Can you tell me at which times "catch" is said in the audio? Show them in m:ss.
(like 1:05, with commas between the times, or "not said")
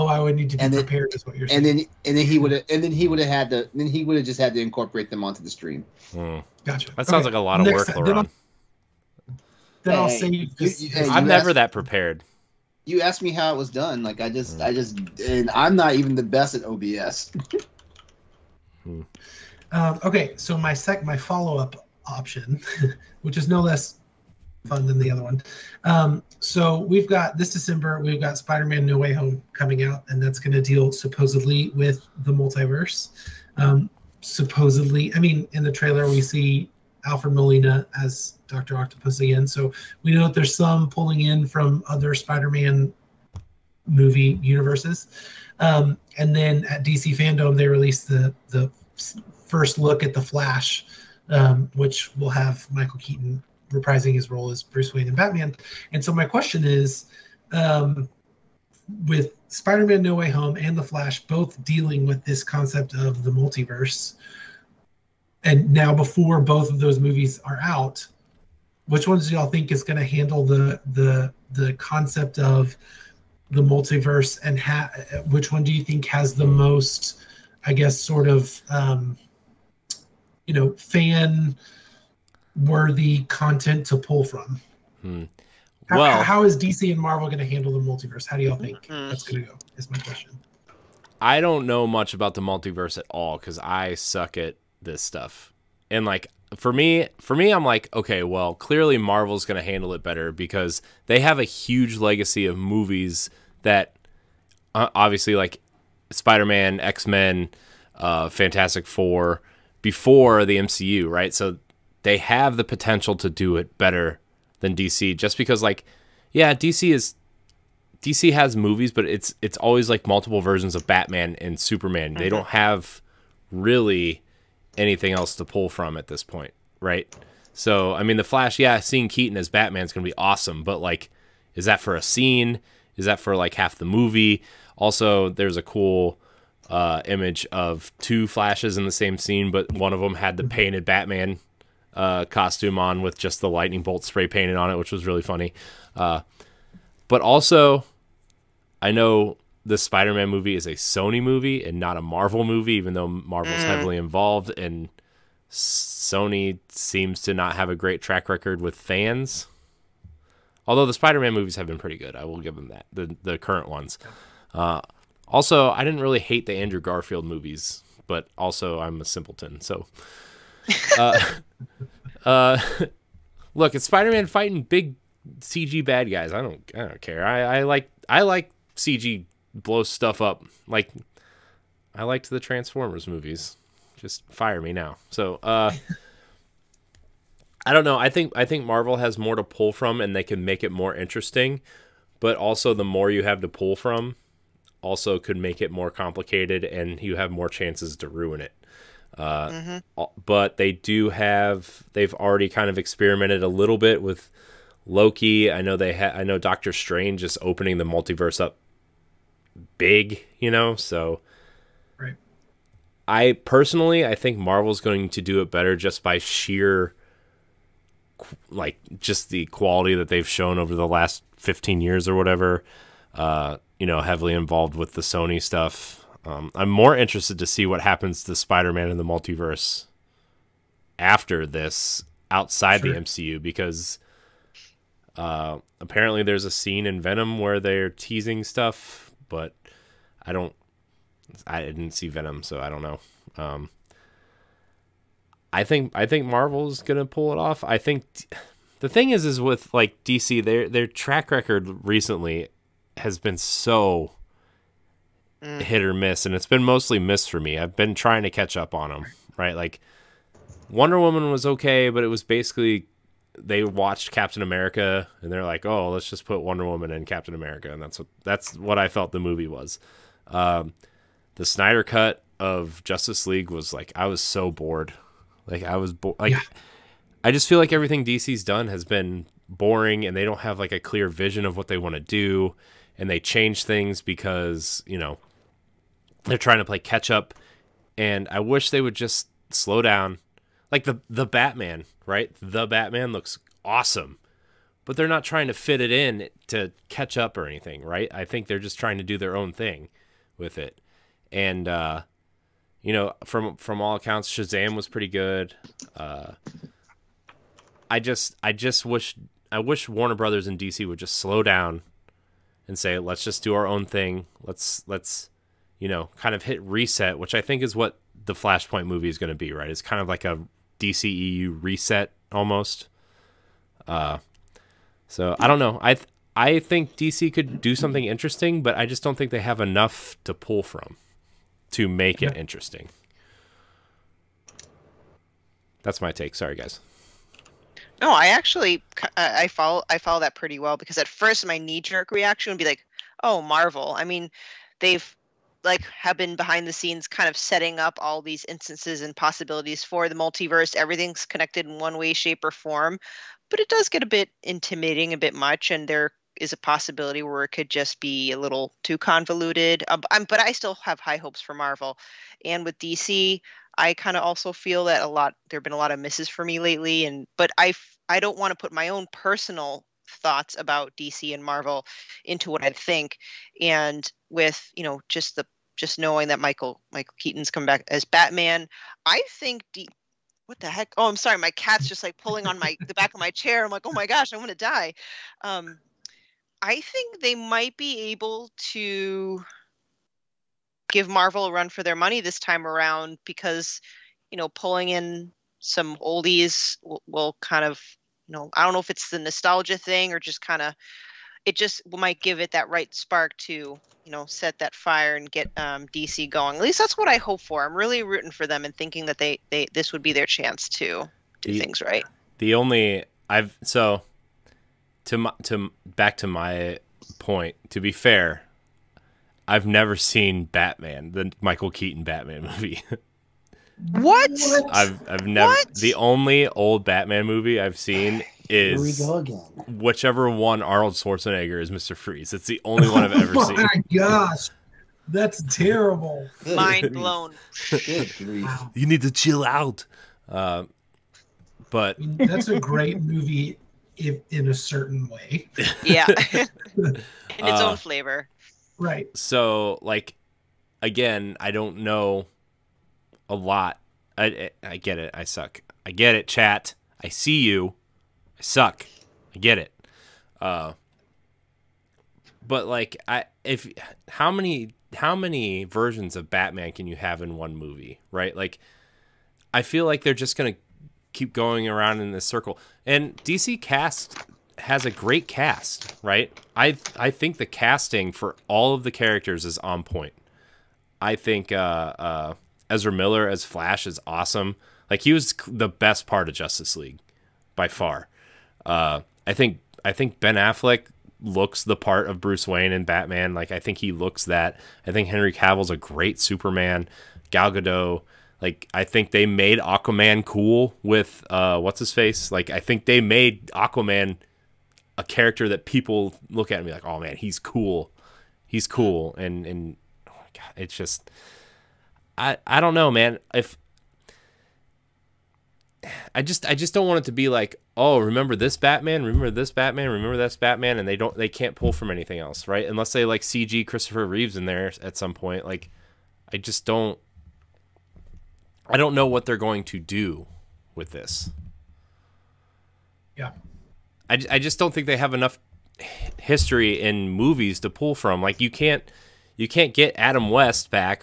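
4:18, 4:46, 4:56.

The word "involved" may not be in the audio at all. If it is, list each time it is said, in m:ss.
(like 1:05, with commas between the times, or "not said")
2:33, 3:44.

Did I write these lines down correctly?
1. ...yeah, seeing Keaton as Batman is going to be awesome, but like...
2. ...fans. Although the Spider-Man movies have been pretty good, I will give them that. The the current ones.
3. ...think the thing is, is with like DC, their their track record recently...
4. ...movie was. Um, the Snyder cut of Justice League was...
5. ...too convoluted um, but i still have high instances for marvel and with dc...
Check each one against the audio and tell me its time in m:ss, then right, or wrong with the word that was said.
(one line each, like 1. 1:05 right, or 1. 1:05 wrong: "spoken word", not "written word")
1. 2:08 right
2. 2:38 right
3. 4:07 right
4. 4:29 right
5. 5:58 wrong: "hopes", not "instances".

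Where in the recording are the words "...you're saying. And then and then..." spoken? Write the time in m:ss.
0:01.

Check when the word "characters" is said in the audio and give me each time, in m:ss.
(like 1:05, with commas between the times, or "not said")
7:58, 8:25.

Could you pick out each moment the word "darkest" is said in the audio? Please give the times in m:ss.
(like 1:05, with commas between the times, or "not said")
not said.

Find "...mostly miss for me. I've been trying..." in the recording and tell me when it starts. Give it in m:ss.
4:16.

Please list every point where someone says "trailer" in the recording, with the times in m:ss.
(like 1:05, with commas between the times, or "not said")
0:35.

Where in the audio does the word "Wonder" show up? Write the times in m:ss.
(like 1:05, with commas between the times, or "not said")
4:20, 4:26.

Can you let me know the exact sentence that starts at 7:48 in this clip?
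Like, I feel like they're just gonna keep going around in this circle.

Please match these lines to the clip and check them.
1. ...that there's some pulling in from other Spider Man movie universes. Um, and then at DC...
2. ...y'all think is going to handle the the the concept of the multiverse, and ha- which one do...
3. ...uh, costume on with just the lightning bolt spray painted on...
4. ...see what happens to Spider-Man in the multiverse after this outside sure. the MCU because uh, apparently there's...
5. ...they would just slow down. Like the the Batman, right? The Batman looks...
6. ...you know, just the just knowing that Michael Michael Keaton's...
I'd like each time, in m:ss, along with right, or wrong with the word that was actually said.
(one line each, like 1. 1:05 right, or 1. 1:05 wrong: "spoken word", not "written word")
1. 0:40 right
2. 1:09 right
3. 2:21 right
4. 3:47 right
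5. 4:48 right
6. 6:14 right.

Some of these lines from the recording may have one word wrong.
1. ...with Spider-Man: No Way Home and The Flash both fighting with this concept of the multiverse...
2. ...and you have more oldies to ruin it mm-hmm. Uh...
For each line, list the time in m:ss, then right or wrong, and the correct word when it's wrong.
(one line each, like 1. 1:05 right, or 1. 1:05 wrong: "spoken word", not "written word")
1. 0:59 wrong: "dealing", not "fighting"
2. 3:16 wrong: "chances", not "oldies".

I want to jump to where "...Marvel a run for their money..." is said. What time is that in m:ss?
6:31.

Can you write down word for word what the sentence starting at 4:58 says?
I think they're just trying to do their own thing with it.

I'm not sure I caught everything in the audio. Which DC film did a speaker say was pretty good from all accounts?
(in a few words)
Shazam.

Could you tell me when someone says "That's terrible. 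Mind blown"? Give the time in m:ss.
7:15.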